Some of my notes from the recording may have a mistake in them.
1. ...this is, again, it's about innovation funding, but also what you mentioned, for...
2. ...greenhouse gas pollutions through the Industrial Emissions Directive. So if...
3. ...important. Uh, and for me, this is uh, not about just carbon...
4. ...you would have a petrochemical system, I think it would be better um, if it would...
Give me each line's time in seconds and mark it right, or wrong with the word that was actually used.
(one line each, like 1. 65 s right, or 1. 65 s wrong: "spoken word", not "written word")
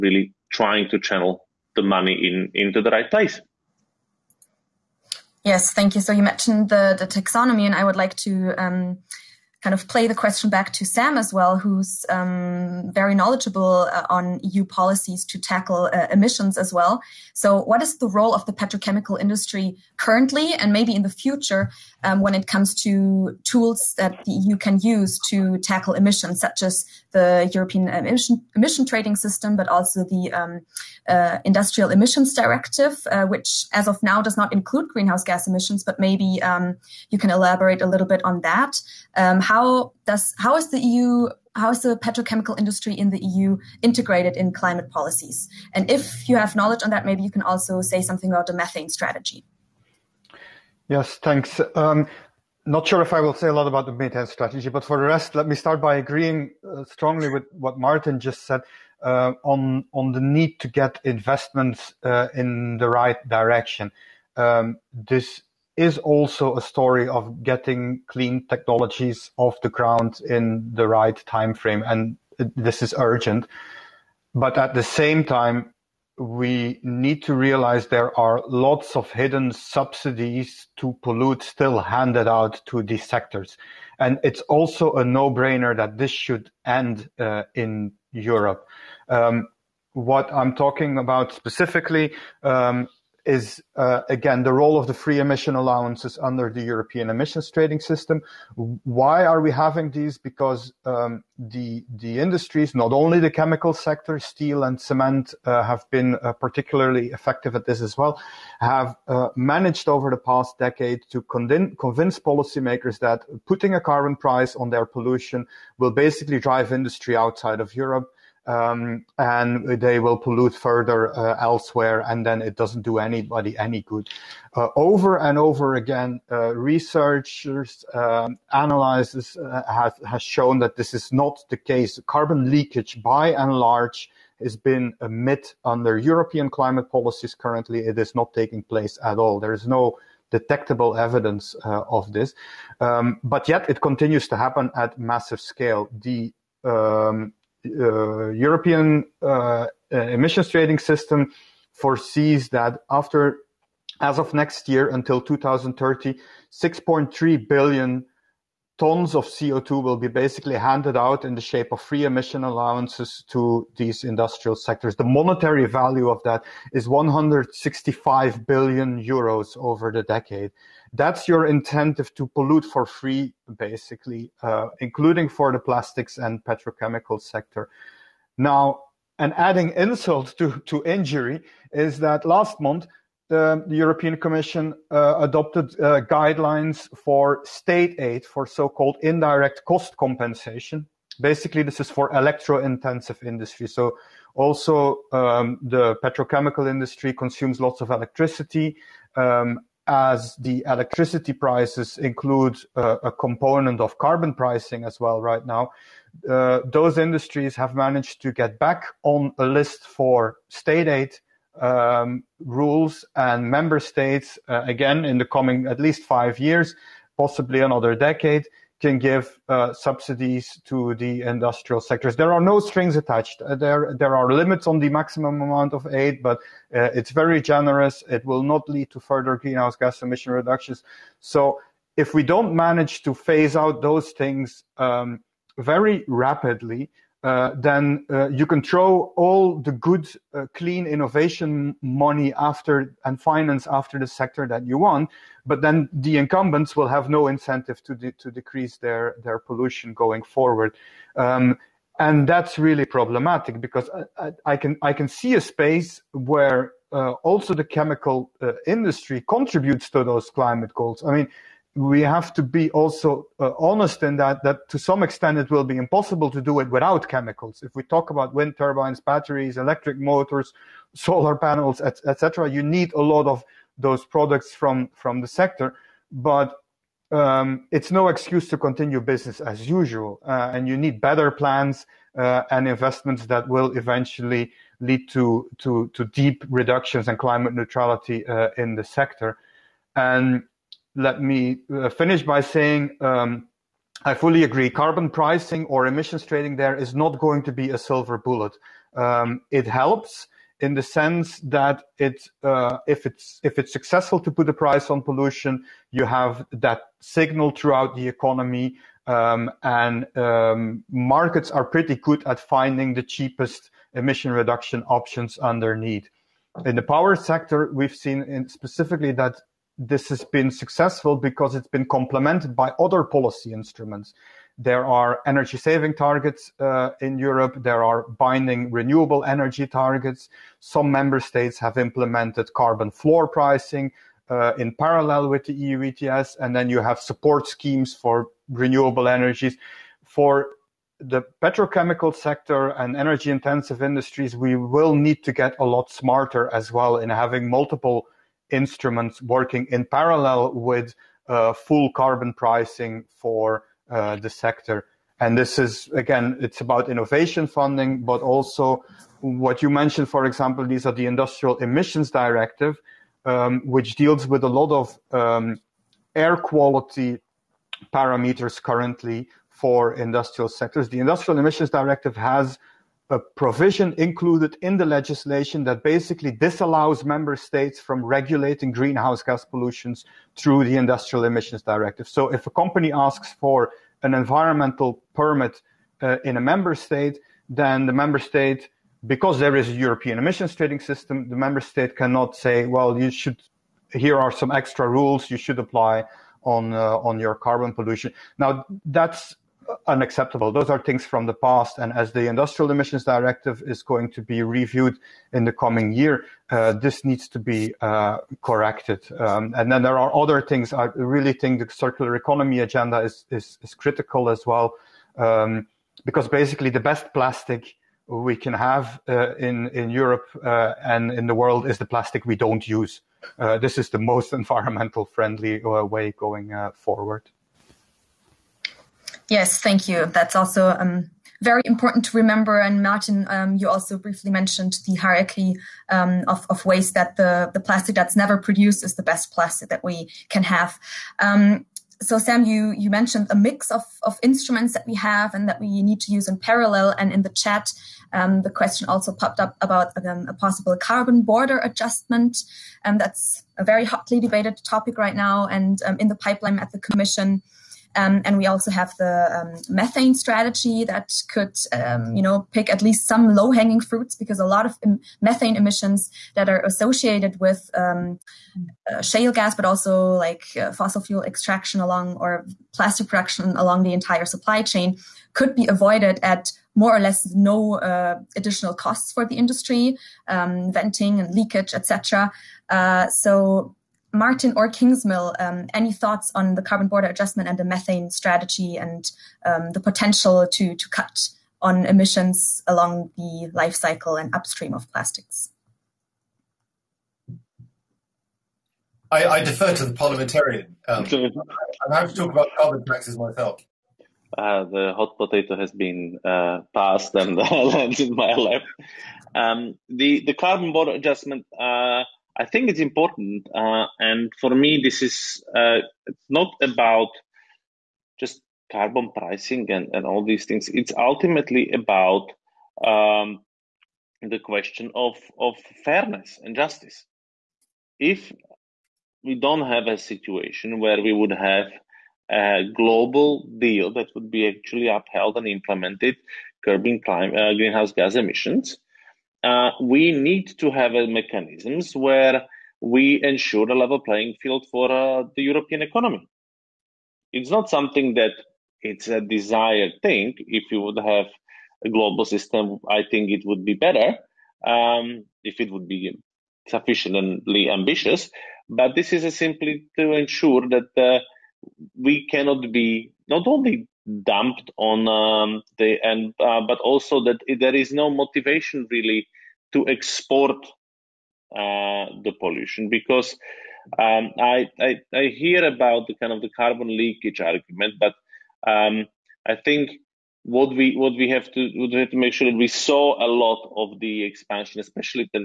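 1. 355 s right
2. 378 s right
3. 512 s right
4. 550 s wrong: "global", not "petrochemical".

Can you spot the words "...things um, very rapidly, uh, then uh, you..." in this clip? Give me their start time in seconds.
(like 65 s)
234 s.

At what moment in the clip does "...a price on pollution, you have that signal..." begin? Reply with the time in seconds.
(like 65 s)
304 s.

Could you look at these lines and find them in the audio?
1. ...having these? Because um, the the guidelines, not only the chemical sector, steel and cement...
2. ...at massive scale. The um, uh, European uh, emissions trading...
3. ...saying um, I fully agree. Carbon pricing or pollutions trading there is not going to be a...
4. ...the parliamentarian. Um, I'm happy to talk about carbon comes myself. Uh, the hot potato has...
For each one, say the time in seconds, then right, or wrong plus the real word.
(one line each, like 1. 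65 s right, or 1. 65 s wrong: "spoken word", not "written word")
1. 99 s wrong: "industries", not "guidelines"
2. 144 s right
3. 292 s wrong: "emissions", not "pollutions"
4. 499 s wrong: "taxes", not "comes".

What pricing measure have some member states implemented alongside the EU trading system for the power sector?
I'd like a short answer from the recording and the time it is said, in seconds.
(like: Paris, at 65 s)
carbon floor pricing, at 332 s.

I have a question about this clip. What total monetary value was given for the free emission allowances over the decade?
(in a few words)
165 billion euros.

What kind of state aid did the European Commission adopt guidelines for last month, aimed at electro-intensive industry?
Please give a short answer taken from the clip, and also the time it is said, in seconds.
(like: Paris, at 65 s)
indirect cost compensation, at 189 s.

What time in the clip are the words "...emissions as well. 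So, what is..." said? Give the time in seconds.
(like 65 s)
16 s.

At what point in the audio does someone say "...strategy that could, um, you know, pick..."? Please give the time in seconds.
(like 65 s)
460 s.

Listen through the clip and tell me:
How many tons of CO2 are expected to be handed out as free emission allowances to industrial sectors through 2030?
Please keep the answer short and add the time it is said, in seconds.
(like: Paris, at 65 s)
6.3 billion tons, at 156 s.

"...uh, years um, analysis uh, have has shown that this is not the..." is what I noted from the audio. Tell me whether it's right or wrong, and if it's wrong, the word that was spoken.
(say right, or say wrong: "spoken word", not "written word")
wrong: "researchers", not "years".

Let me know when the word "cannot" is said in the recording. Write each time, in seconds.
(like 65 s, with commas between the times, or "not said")
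391 s, 562 s.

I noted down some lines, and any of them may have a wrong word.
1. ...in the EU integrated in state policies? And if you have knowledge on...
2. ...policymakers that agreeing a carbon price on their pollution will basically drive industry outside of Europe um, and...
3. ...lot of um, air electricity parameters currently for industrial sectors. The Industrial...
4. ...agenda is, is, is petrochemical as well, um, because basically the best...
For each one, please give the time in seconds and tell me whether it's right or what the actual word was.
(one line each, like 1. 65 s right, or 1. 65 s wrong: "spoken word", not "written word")
1. 42 s wrong: "climate", not "state"
2. 112 s wrong: "putting", not "agreeing"
3. 364 s wrong: "quality", not "electricity"
4. 412 s wrong: "critical", not "petrochemical".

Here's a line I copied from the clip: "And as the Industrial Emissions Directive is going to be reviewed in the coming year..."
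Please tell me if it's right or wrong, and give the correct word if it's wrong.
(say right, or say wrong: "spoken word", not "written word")
right.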